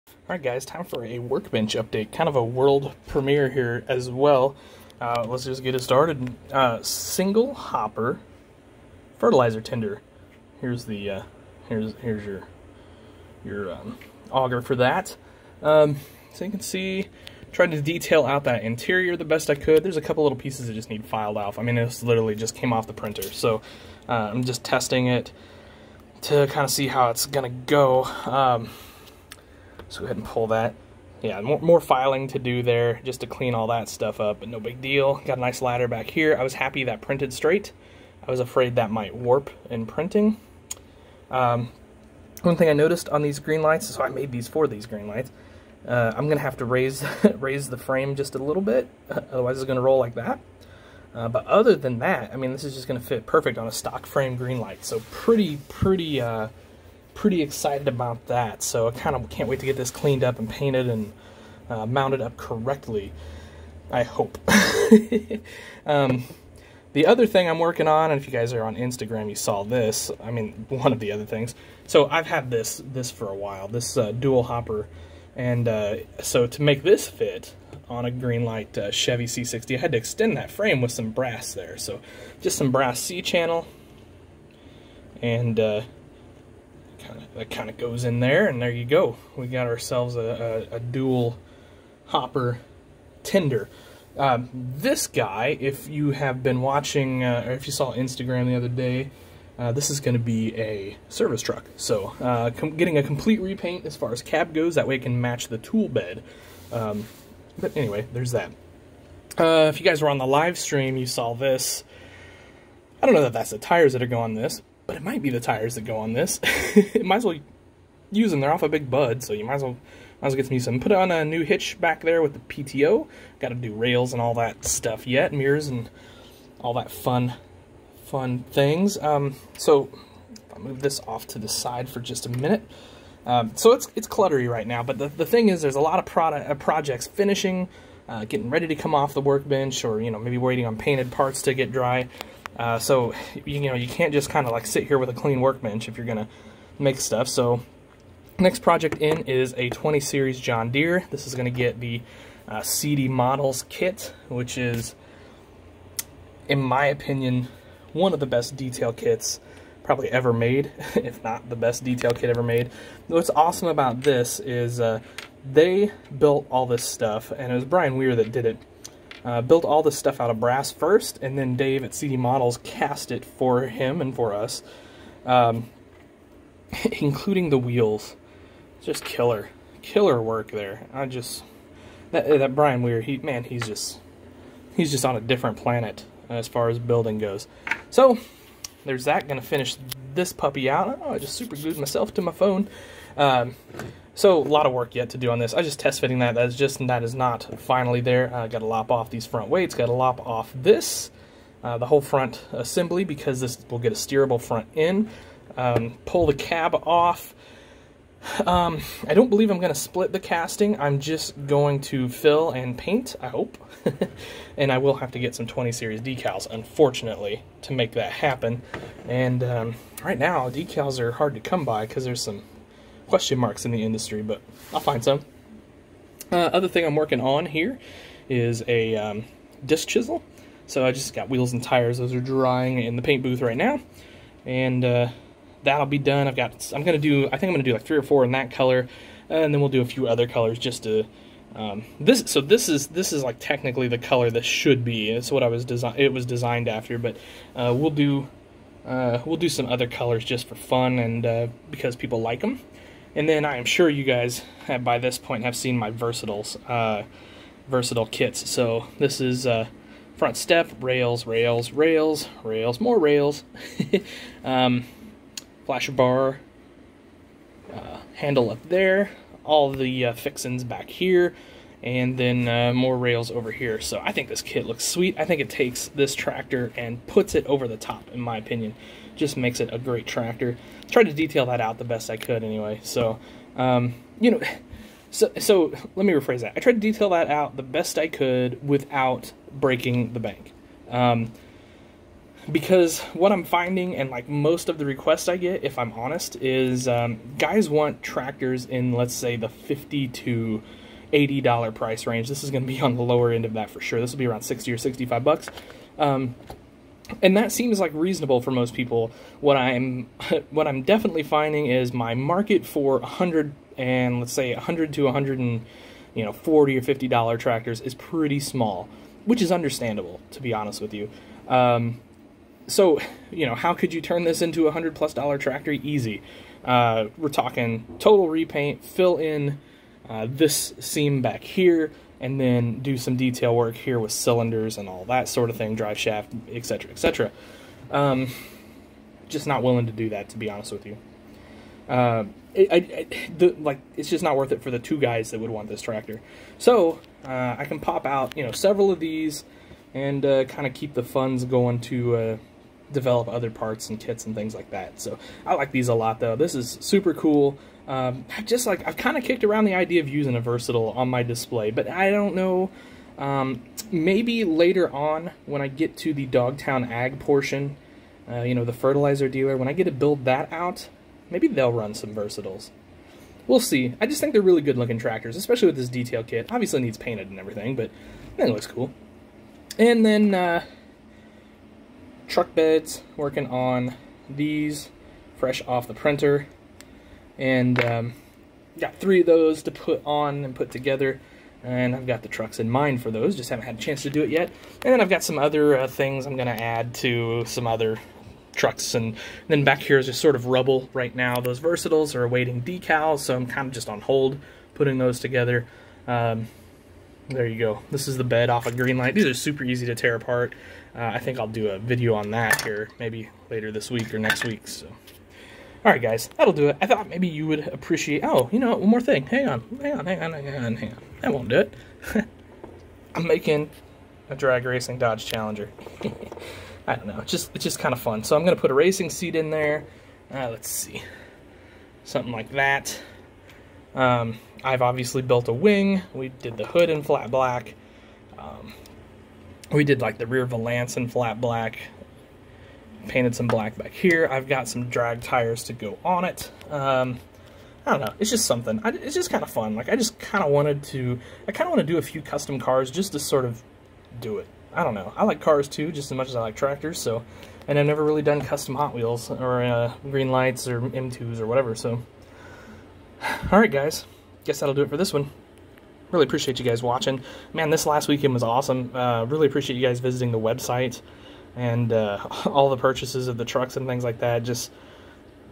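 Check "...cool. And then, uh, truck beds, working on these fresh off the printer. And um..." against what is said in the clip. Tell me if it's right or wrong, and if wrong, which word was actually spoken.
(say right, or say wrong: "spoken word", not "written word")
right.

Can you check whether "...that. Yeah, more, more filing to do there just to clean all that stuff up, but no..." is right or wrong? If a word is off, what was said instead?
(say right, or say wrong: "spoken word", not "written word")
right.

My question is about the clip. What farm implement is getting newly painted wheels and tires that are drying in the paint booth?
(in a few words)
Disc chisel.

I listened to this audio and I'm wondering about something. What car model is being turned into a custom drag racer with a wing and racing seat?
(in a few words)
Dodge Challenger.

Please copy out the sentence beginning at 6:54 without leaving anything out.
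So, all right, guys, that'll do it.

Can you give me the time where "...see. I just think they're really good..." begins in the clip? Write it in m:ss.
6:13.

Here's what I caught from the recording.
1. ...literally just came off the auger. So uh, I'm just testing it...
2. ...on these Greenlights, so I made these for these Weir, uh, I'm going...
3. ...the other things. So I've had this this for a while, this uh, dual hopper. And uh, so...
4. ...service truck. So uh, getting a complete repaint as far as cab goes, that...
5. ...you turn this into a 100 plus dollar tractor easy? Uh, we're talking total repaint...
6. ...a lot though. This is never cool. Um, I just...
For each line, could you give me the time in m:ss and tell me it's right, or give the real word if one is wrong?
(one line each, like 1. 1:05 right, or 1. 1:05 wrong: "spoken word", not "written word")
1. 0:22 wrong: "printer", not "auger"
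2. 0:43 wrong: "Greenlights", not "Weir"
3. 1:10 right
4. 1:41 right
5. 5:23 right
6. 5:55 wrong: "super", not "never".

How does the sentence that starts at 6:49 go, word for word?
These are super easy to tear apart.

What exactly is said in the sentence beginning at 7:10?
Uh, let's see, something like that.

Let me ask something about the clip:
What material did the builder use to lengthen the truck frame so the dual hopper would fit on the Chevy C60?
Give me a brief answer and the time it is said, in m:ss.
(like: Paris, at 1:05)
Brass C-channel, at 1:22.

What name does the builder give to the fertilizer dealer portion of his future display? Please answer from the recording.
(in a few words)
Dogtown Ag.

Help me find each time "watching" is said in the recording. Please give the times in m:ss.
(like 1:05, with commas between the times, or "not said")
1:36, 7:46.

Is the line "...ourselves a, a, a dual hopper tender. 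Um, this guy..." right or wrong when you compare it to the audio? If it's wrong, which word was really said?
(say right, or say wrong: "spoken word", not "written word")
right.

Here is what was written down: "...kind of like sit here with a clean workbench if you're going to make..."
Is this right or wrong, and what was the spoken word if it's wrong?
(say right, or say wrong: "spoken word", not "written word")
right.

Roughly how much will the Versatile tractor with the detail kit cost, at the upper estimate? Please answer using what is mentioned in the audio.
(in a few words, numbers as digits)
$65.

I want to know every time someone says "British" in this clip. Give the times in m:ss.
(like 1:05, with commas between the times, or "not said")
not said.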